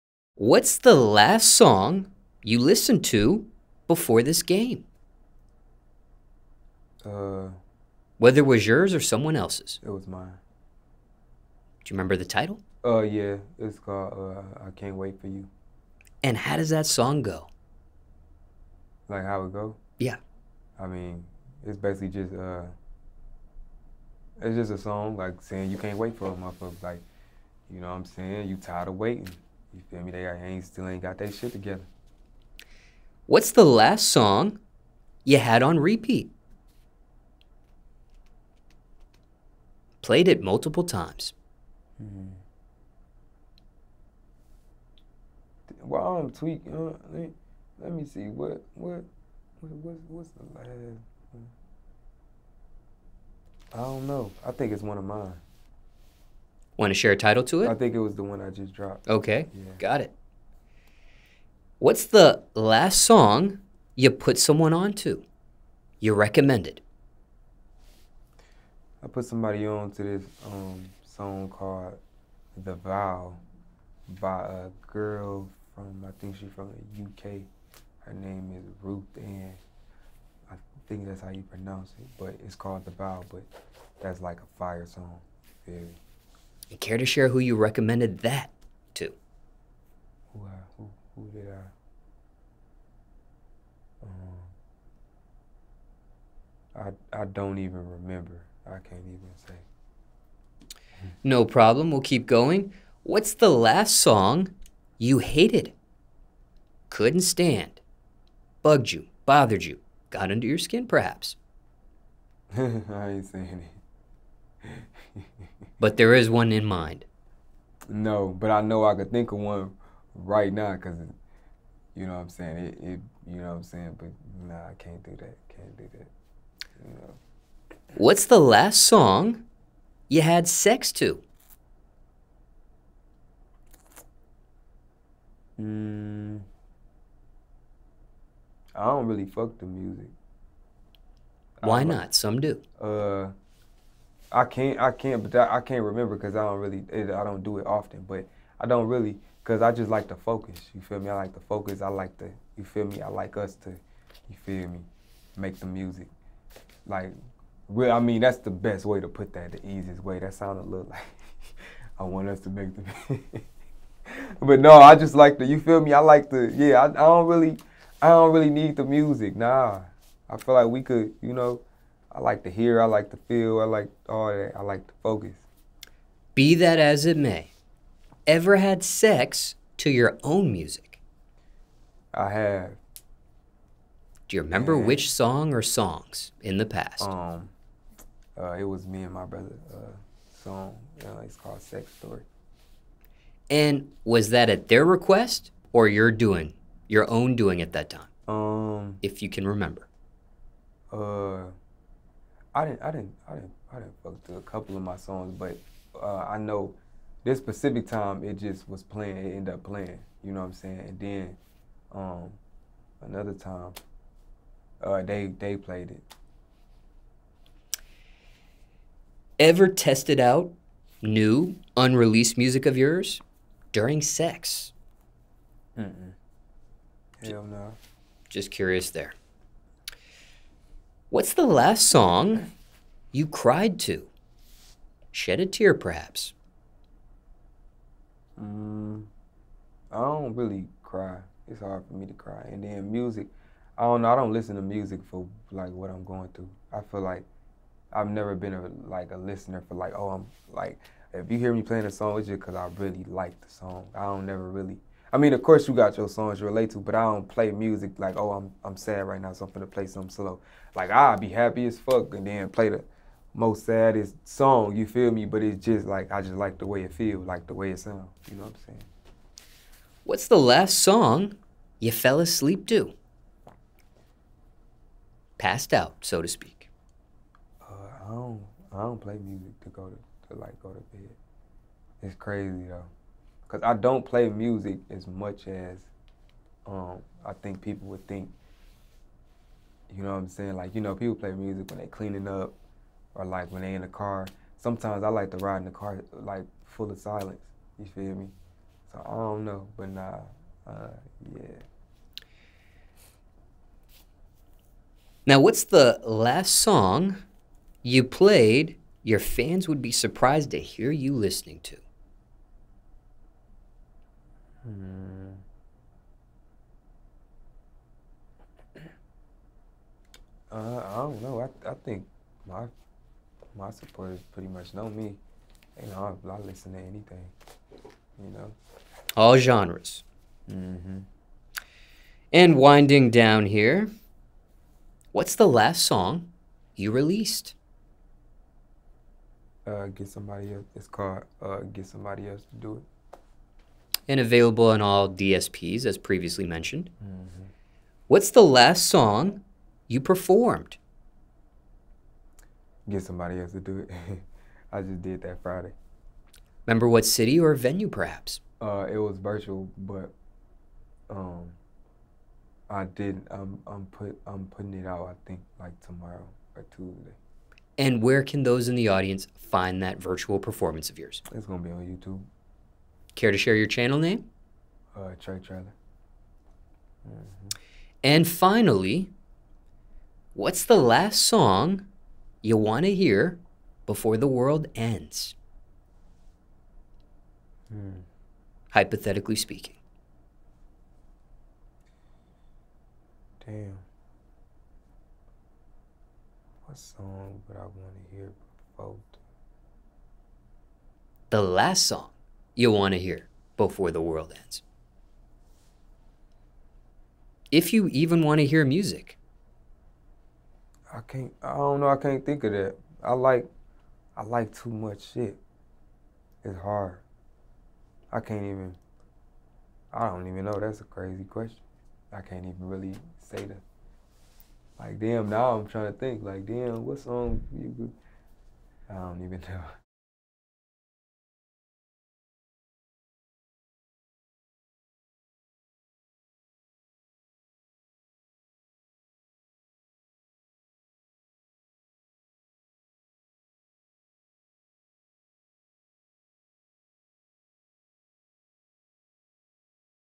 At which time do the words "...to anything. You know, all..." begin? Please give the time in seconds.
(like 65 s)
326 s.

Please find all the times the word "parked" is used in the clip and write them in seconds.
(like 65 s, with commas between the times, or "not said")
not said.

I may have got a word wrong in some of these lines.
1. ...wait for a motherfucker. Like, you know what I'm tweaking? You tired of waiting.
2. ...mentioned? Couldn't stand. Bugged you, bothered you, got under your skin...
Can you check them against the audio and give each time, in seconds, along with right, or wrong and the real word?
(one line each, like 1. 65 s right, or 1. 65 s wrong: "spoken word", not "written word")
1. 25 s wrong: "saying", not "tweaking"
2. 105 s wrong: "hated", not "mentioned".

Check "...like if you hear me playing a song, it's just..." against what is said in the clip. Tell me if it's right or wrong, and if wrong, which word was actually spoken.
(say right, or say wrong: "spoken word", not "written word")
right.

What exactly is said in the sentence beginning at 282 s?
It's crazy though because I don't play music as much as um, I think people would think.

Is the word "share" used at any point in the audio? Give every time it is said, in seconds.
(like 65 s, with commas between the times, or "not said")
56 s, 87 s, 373 s.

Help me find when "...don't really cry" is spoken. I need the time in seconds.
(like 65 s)
239 s.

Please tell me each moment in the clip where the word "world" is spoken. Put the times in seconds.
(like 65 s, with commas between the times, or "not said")
384 s, 404 s.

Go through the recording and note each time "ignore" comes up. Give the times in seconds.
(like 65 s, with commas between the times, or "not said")
not said.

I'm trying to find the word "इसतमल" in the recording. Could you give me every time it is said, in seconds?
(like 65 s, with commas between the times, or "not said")
not said.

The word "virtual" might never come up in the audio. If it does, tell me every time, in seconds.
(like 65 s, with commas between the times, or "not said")
359 s, 370 s.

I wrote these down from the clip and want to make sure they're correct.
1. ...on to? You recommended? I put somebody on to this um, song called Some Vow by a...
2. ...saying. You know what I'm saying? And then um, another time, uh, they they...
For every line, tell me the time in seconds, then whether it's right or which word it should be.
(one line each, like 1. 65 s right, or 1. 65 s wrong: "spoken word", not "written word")
1. 64 s wrong: "The", not "Some"
2. 209 s wrong: "playing", not "saying".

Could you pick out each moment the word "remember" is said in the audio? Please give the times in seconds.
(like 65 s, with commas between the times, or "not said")
11 s, 97 s, 145 s, 184 s, 199 s, 356 s.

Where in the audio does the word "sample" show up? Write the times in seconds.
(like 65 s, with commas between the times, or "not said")
not said.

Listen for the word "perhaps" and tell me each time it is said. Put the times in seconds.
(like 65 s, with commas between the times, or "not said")
110 s, 235 s, 357 s.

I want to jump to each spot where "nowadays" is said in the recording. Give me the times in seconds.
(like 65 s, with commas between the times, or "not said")
not said.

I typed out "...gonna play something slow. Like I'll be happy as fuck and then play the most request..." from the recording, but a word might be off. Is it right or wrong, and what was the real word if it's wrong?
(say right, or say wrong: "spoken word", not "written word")
wrong: "saddest", not "request".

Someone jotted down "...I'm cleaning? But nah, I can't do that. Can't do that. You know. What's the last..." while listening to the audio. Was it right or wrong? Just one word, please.
wrong.